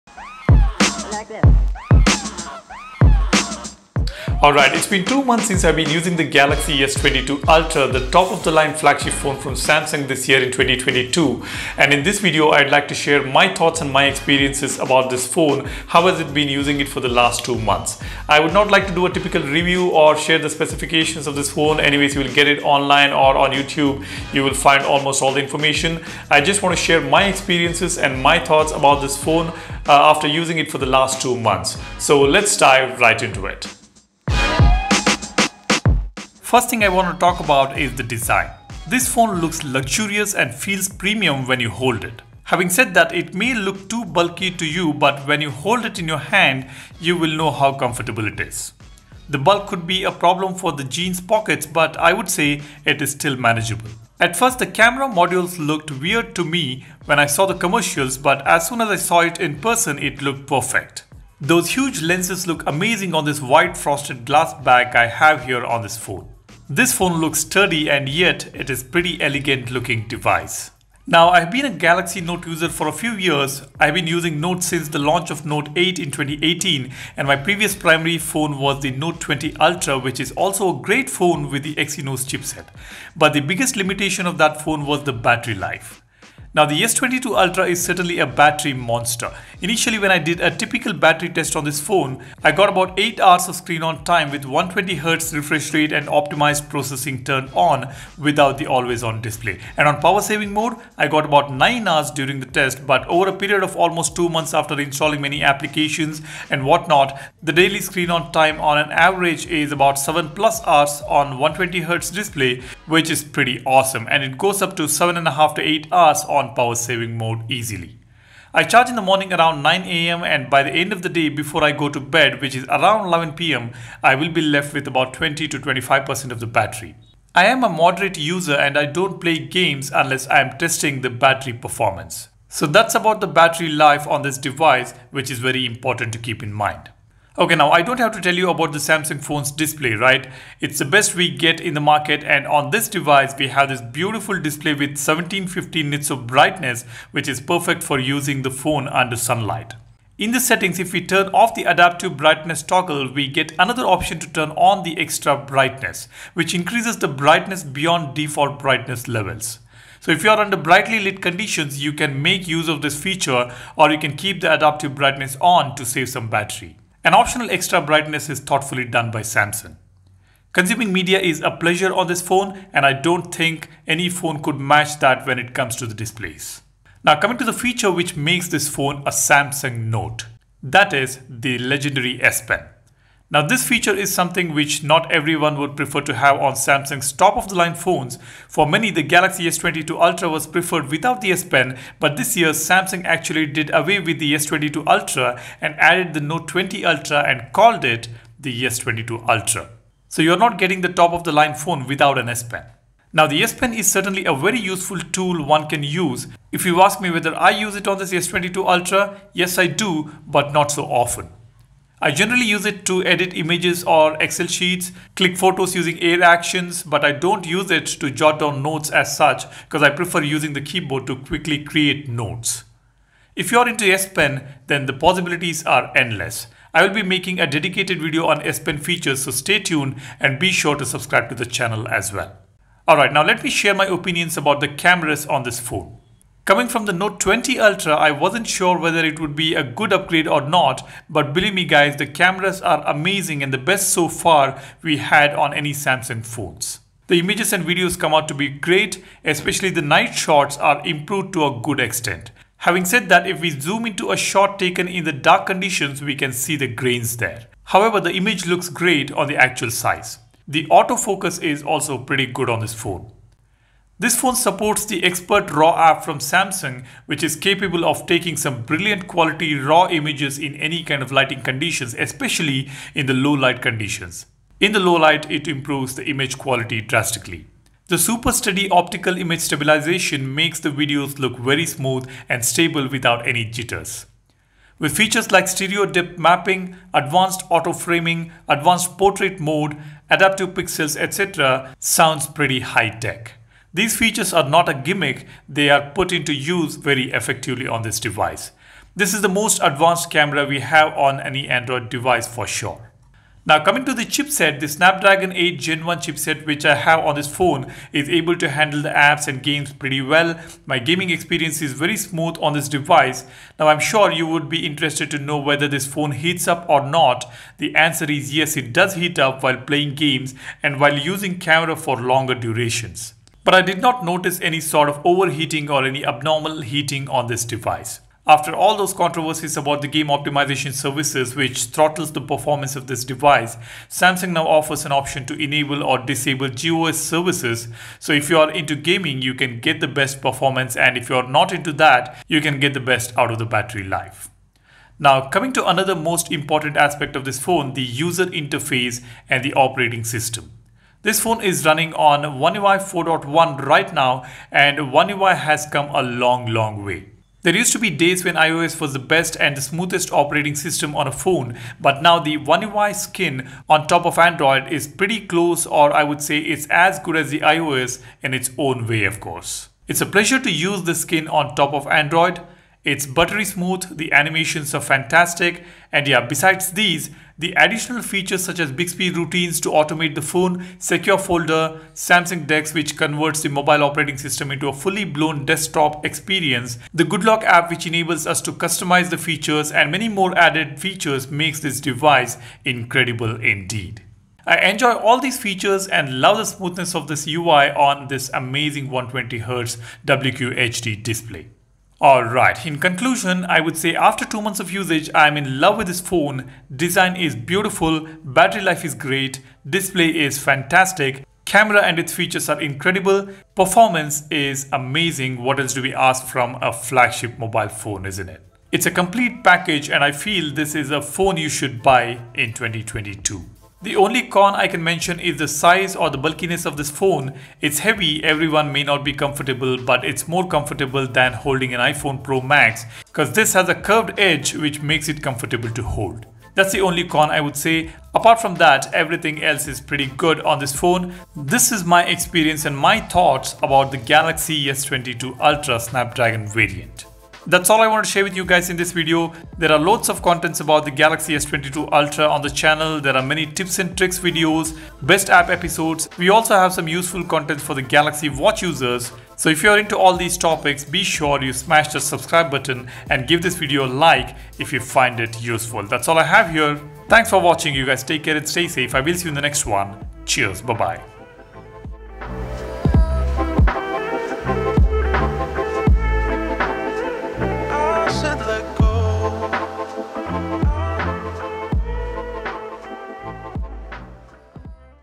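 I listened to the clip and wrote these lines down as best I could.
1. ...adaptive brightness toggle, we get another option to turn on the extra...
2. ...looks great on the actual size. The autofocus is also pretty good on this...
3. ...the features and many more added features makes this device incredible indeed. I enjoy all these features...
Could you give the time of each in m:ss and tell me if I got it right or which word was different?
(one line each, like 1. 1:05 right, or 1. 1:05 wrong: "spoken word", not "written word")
1. 2:31 right
2. 4:18 right
3. 6:29 right.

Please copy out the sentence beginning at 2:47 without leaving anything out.
An optional extra brightness is thoughtfully done by Samsung.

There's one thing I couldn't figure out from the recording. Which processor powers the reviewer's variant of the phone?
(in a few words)
Snapdragon 8 Gen 1.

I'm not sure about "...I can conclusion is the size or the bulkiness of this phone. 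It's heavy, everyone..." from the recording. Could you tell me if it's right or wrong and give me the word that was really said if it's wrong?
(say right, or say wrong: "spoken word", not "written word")
wrong: "mention", not "conclusion".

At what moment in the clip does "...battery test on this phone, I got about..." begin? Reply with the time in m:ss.
1:30.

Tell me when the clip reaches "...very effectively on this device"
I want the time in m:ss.
4:56.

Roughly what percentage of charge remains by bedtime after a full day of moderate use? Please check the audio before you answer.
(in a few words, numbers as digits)
20 to 25%.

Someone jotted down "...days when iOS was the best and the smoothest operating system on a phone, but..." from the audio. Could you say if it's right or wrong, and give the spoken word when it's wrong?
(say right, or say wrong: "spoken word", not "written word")
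right.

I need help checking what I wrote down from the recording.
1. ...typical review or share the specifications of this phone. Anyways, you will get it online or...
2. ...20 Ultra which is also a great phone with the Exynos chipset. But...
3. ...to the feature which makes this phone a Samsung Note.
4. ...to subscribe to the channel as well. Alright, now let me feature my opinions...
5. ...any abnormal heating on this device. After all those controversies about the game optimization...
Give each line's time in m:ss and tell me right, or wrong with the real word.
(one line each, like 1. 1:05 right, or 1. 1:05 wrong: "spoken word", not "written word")
1. 0:19 right
2. 1:19 right
3. 2:57 right
4. 3:50 wrong: "share", not "feature"
5. 5:25 right.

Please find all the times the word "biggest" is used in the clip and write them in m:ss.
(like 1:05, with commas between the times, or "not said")
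1:23.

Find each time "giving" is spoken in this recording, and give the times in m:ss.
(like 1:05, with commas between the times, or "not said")
not said.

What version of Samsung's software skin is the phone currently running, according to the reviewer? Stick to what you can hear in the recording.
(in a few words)
One UI 4.1.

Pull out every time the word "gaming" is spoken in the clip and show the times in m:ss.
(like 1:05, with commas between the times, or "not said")
5:10, 5:38.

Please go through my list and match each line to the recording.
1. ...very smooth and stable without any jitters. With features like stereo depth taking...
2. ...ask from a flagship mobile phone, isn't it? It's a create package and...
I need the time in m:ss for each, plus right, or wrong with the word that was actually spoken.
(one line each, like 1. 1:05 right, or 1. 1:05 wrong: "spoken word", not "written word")
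1. 4:41 wrong: "mapping", not "taking"
2. 6:55 wrong: "complete", not "create".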